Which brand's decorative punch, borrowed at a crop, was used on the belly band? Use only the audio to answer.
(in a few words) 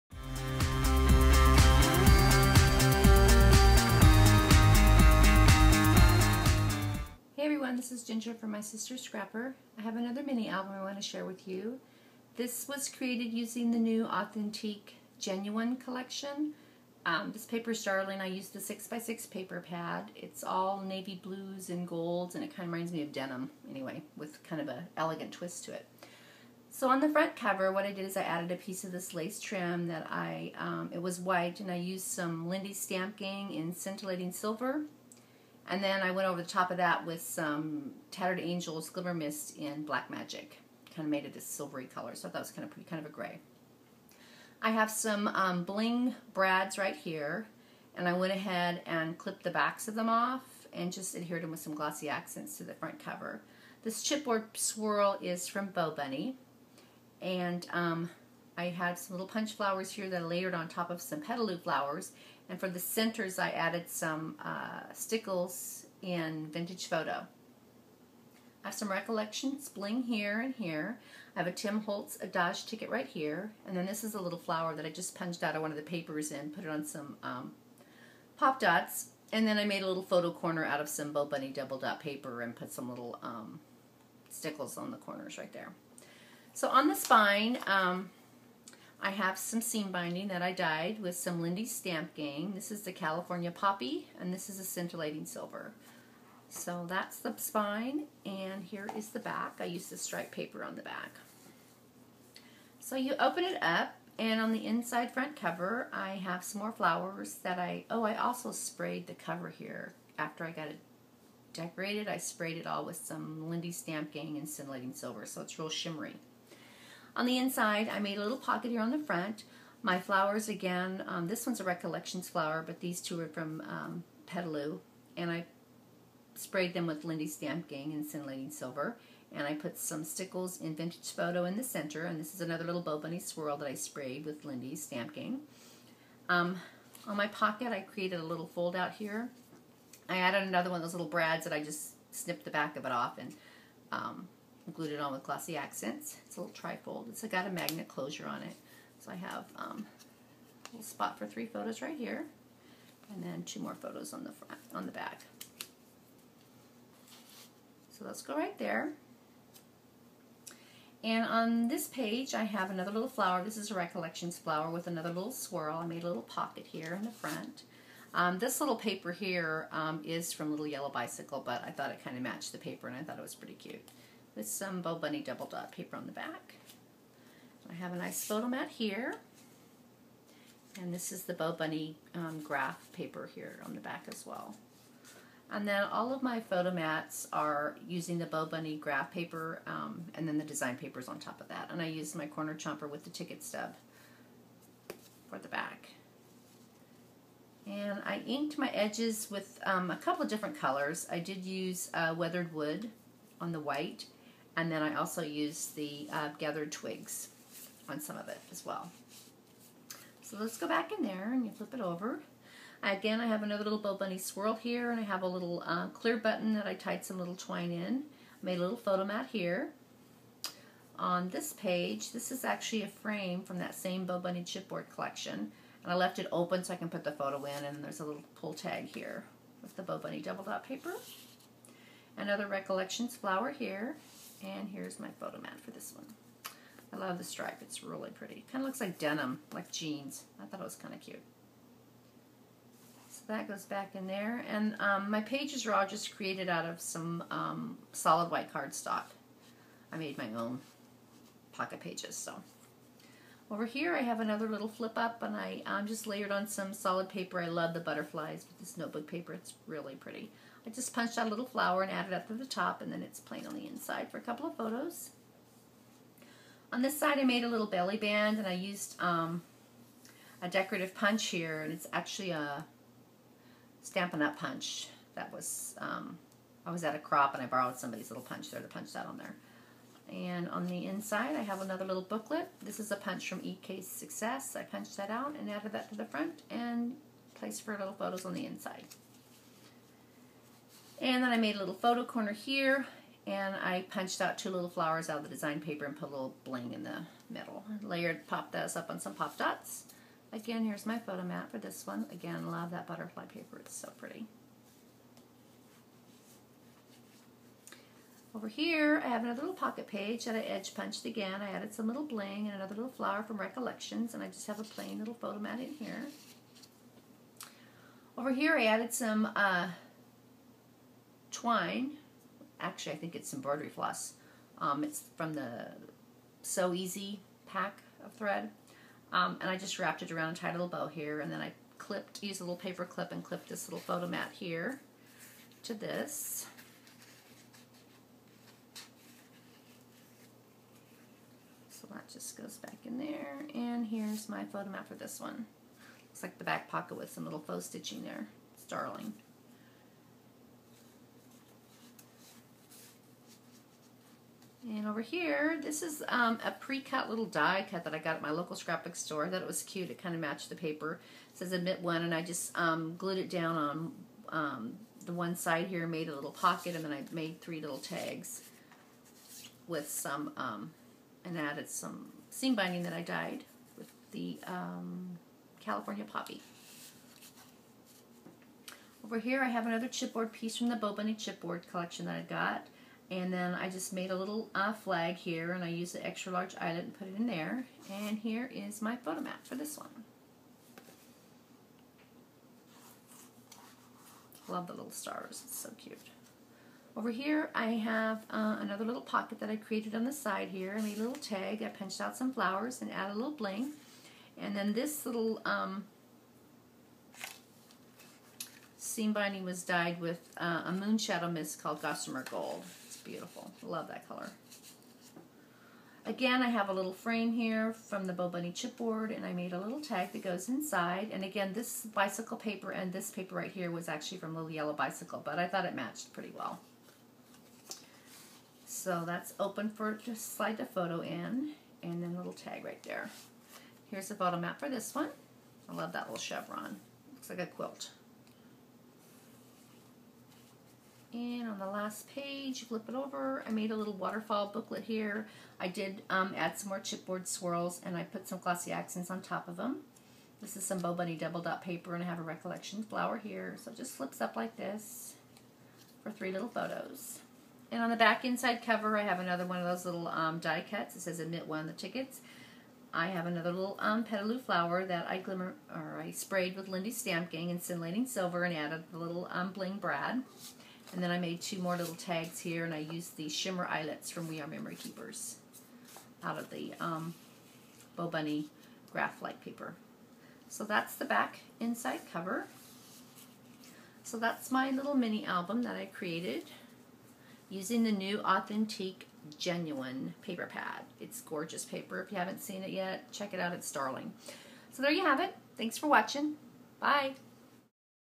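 Stampin' Up!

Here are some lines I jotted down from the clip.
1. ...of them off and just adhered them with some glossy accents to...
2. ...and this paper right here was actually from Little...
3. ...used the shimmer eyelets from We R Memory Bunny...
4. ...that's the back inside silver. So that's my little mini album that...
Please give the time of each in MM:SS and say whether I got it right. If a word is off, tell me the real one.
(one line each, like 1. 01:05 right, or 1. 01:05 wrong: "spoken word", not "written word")
1. 00:49 right
2. 07:02 right
3. 07:52 wrong: "Keepers", not "Bunny"
4. 08:00 wrong: "cover", not "silver".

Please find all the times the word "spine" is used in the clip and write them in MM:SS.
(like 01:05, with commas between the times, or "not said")
01:26, 01:37.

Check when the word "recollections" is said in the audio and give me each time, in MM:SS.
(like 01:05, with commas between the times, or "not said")
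01:08, 02:01, 02:43, 03:52, 05:13, 07:32.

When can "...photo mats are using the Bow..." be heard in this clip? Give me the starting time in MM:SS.
03:06.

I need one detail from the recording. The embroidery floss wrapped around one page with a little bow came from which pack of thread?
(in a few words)
So Easy.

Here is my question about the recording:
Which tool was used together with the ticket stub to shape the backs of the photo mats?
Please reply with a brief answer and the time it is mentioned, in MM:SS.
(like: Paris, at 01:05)
Corner chomper, at 03:12.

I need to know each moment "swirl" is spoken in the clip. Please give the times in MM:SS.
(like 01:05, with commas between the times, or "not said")
00:54, 02:13, 02:45, 03:34, 07:27.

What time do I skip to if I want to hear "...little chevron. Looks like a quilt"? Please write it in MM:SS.
07:16.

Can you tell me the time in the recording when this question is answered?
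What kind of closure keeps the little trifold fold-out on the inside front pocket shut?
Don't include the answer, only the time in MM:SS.
02:27.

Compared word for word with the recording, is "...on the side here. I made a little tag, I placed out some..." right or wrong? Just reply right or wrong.
wrong.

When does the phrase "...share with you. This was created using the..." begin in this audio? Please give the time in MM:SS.
00:11.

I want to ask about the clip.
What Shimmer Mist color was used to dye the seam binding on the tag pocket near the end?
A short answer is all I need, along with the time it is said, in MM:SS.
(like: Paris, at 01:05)
Gossamer Gold, at 06:51.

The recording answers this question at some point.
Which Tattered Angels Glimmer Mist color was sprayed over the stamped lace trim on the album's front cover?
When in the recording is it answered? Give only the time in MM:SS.
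00:39.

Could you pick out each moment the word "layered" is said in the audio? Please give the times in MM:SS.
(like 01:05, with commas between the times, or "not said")
01:00, 04:16, 04:57.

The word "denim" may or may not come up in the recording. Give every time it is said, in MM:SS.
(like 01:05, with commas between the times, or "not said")
00:23, 03:58.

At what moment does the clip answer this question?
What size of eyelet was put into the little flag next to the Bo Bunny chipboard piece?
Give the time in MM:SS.
06:26.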